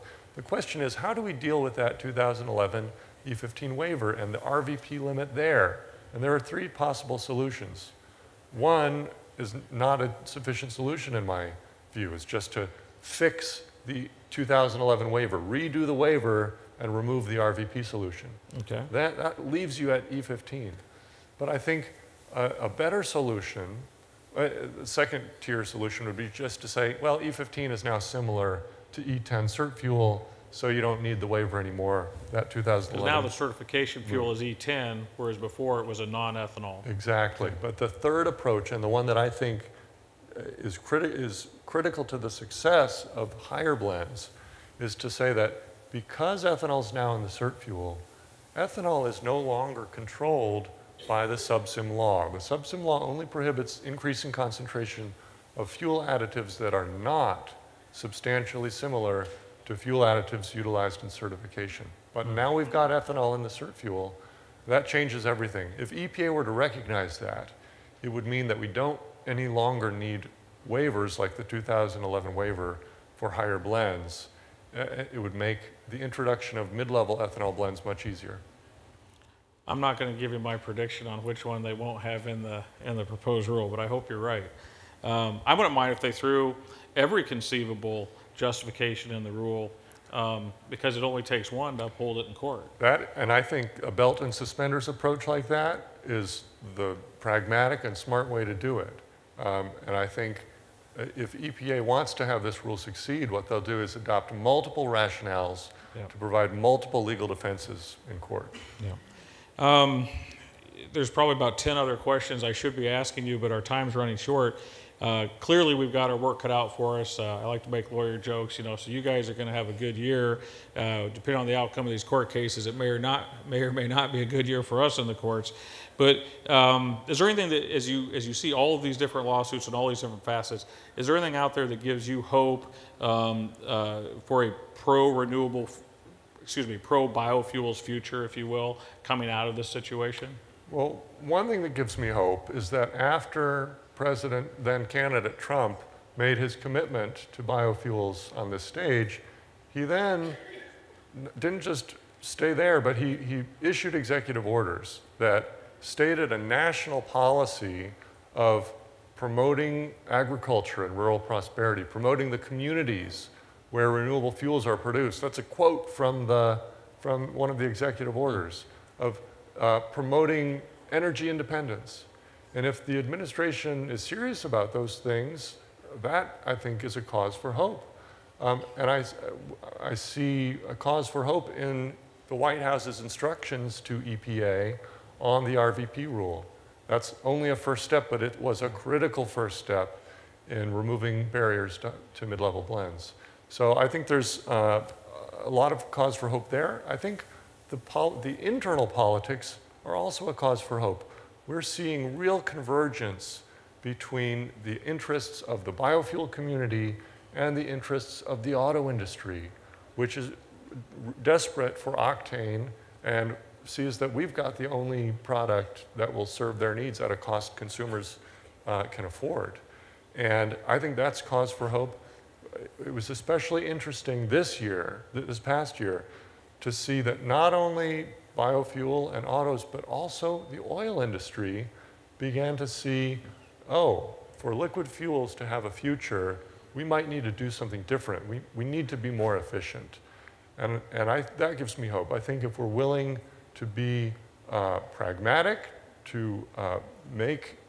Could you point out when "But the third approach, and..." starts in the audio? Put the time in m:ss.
0:37.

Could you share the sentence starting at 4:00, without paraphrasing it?
And, and I, that gives me hope.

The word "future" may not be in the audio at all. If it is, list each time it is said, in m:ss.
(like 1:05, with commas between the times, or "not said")
2:17, 3:55.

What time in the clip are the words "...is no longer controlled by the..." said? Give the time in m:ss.
0:49.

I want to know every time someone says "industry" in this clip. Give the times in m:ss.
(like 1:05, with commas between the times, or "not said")
3:28, 3:51.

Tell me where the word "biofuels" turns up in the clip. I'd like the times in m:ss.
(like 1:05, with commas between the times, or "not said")
2:17, 2:27, 3:25, 3:48.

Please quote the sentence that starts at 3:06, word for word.
That's only a first step, but it was a critical first step in removing barriers to, to mid-level blends.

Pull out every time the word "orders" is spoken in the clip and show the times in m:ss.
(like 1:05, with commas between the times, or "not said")
2:34, 2:48.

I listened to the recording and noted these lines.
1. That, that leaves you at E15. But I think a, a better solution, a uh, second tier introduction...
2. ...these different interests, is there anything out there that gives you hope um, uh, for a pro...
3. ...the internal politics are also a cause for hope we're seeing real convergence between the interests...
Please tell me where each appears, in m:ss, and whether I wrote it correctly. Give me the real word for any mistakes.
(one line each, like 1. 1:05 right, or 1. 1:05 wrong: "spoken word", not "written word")
1. 0:18 wrong: "solution", not "introduction"
2. 2:09 wrong: "facets", not "interests"
3. 3:18 right.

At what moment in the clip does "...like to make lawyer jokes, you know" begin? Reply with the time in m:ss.
1:57.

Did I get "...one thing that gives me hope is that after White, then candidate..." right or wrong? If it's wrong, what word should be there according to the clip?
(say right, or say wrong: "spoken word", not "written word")
wrong: "President", not "White".